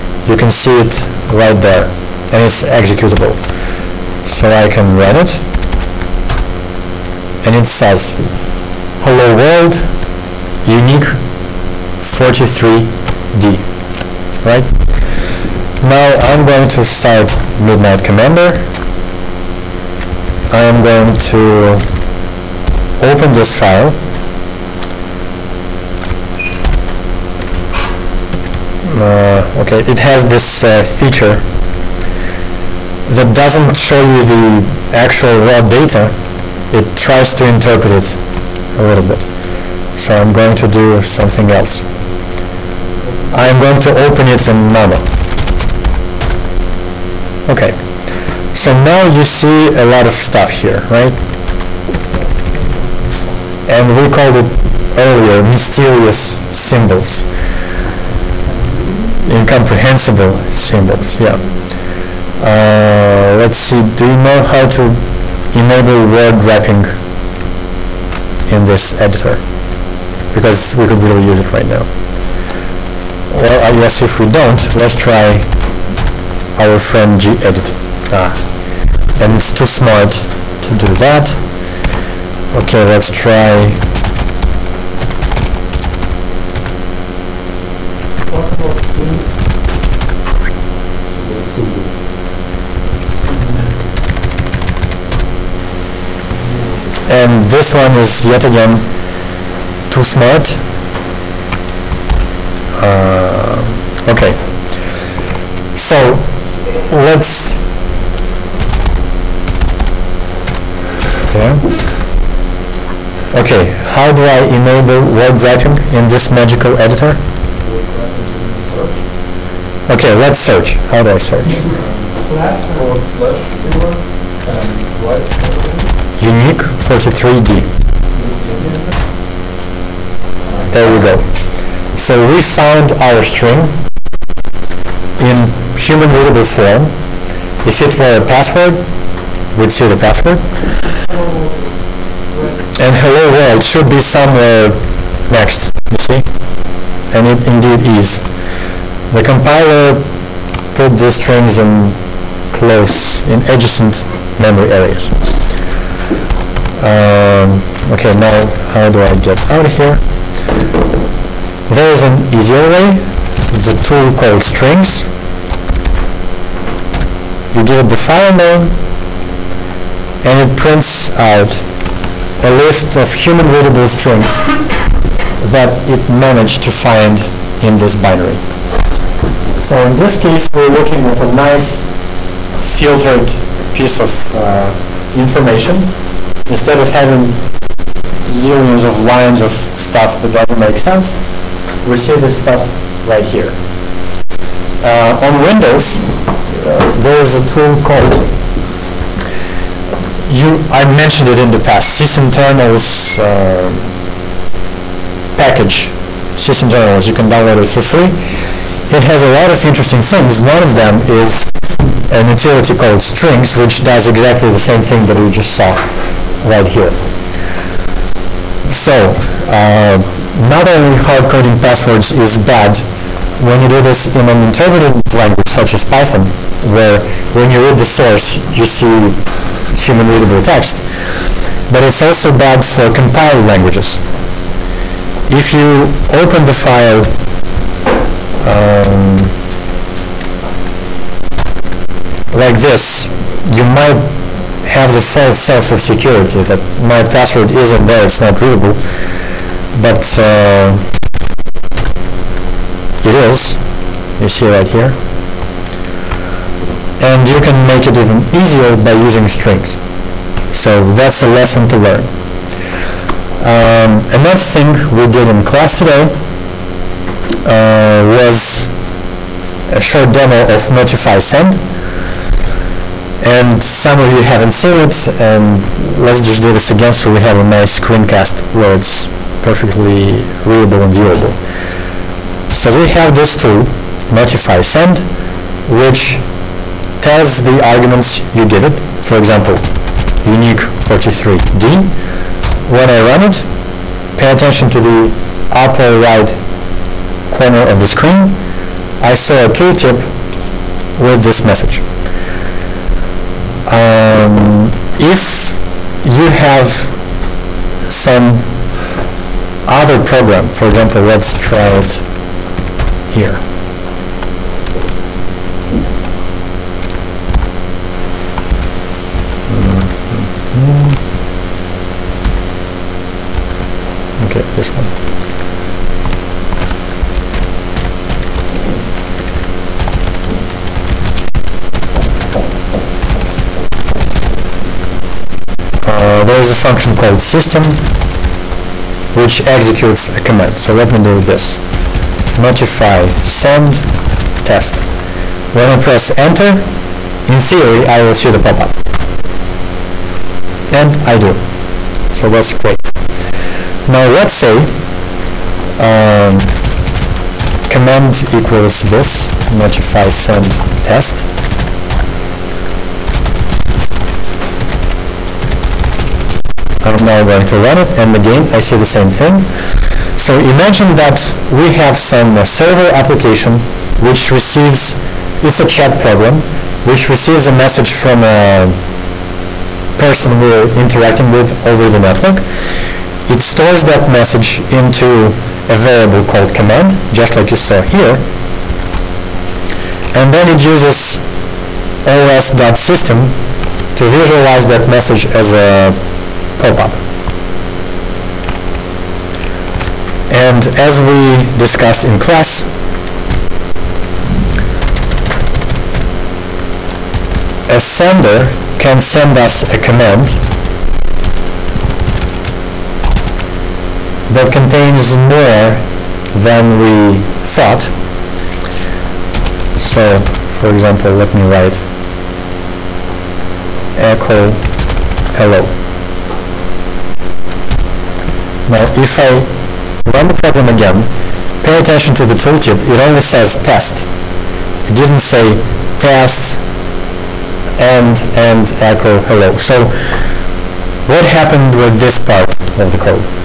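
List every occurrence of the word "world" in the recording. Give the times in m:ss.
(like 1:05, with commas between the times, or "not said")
0:09, 2:23.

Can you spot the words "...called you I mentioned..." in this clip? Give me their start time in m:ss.
3:17.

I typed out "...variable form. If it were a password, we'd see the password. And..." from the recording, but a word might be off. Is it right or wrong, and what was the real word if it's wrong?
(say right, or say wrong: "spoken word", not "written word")
wrong: "readable", not "variable".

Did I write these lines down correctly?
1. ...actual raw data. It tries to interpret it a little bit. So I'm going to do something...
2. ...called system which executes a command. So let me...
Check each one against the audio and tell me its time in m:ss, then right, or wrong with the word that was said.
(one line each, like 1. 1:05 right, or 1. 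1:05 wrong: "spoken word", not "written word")
1. 0:34 right
2. 5:36 right.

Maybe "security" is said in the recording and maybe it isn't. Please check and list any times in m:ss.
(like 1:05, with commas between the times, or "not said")
4:05.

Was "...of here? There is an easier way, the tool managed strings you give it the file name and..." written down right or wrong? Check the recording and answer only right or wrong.
wrong.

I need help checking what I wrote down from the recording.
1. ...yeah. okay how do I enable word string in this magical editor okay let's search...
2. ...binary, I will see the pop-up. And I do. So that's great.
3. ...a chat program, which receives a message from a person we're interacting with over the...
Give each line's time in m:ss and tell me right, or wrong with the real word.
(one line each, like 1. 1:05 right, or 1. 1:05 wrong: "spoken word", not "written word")
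1. 1:51 wrong: "wrapping", not "string"
2. 5:47 wrong: "theory", not "binary"
3. 6:15 right.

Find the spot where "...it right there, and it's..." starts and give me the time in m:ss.
0:00.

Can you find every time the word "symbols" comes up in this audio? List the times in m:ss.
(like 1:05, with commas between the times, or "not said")
0:56, 1:00.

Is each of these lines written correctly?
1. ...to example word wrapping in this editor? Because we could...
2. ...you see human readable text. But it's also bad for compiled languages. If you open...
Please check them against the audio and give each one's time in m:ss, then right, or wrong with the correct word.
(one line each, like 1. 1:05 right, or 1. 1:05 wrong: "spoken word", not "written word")
1. 1:04 wrong: "enable", not "example"
2. 3:48 right.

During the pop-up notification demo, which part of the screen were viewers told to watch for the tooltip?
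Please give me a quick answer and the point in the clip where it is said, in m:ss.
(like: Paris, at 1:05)
upper right corner, at 4:55.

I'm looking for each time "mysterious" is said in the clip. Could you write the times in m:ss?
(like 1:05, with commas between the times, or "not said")
0:55.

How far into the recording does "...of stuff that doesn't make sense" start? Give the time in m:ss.
3:09.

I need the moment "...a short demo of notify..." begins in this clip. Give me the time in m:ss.
4:29.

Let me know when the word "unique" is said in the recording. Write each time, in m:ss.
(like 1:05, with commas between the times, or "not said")
0:10, 2:06, 4:50.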